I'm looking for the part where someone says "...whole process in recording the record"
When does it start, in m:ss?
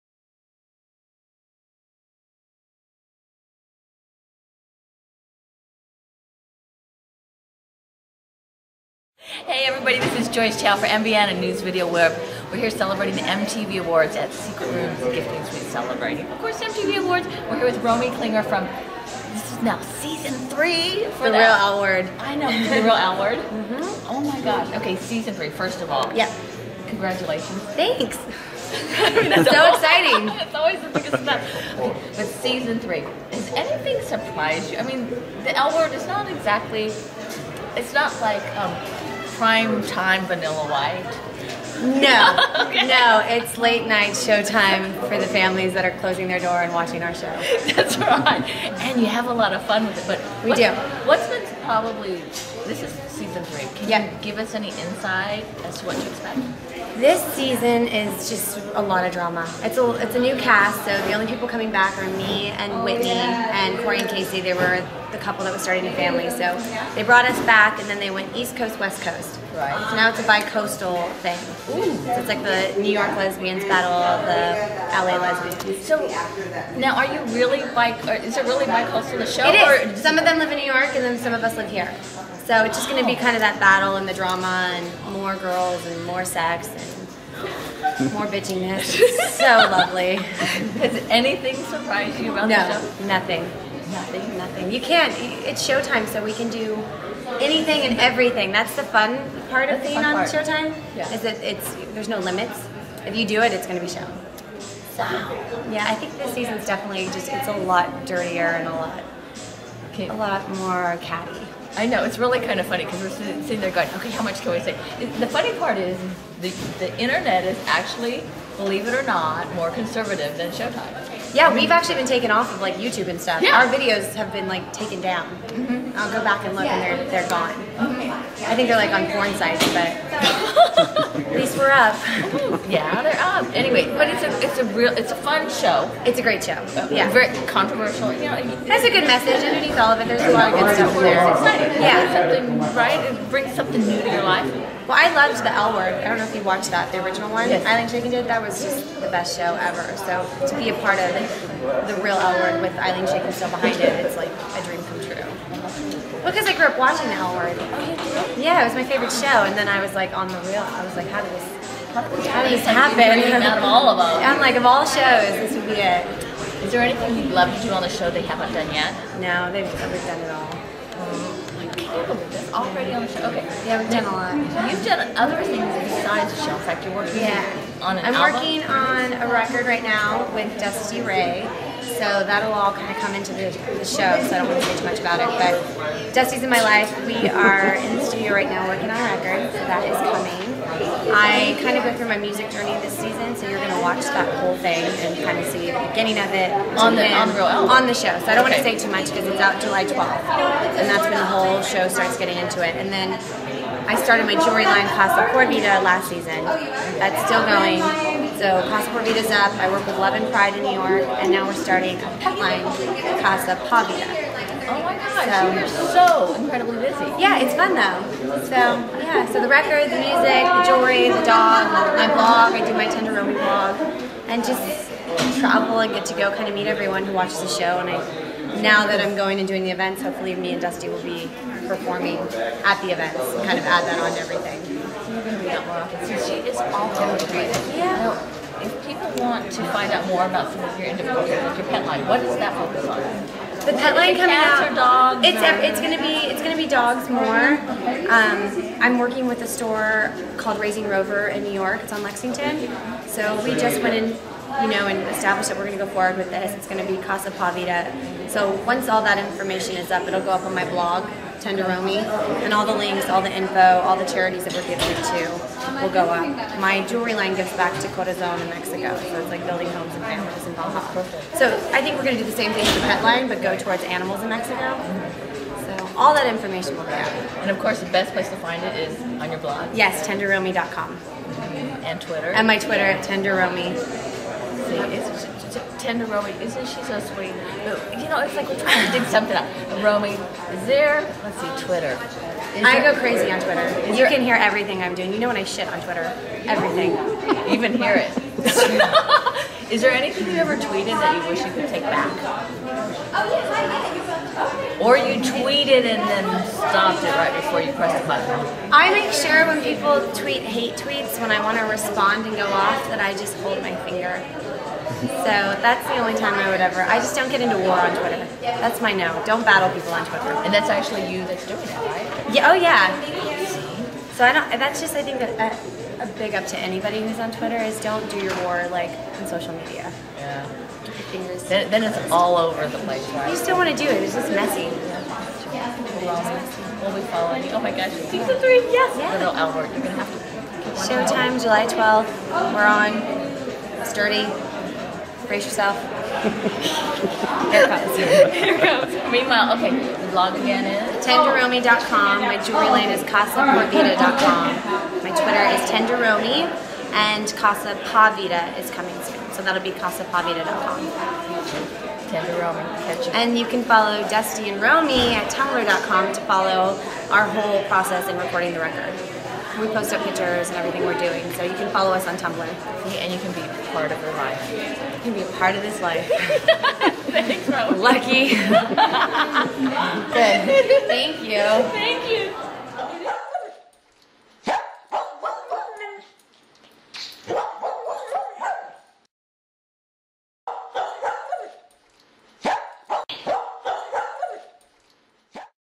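6:07.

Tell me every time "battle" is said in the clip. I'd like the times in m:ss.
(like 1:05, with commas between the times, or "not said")
1:13, 1:23, 5:19.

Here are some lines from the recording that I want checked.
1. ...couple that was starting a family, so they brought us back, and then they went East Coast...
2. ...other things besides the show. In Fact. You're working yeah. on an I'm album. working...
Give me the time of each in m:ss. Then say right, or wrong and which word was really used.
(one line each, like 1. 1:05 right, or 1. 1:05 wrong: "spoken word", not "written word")
1. 1:05 right
2. 2:55 right.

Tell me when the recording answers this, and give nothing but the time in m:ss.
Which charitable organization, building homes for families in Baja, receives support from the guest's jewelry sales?
4:27.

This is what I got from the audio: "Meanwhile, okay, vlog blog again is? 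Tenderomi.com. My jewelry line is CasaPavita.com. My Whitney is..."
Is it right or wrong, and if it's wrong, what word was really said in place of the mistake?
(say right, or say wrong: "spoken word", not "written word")
wrong: "Twitter", not "Whitney".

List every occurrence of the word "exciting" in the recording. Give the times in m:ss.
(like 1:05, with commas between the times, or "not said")
0:29, 2:21.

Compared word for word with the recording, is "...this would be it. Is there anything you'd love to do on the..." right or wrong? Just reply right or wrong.
right.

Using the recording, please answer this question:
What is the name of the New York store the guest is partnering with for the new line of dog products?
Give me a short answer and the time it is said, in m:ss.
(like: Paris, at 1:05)
Raising Rover, at 4:10.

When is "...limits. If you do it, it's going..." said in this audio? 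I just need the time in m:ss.
1:42.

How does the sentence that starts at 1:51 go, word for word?
I know it's really kind of funny because we're sitting there going, okay, how much can we say?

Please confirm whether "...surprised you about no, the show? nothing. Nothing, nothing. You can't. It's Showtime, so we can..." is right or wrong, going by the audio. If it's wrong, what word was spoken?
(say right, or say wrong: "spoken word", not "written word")
right.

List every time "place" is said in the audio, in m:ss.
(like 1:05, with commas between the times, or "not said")
4:38, 5:32.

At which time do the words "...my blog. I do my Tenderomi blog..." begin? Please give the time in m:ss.
3:41.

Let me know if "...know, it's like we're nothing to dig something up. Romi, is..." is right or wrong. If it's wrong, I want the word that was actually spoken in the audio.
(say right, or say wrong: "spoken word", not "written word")
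wrong: "trying", not "nothing".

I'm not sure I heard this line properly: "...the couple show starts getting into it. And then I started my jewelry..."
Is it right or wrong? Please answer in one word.
wrong.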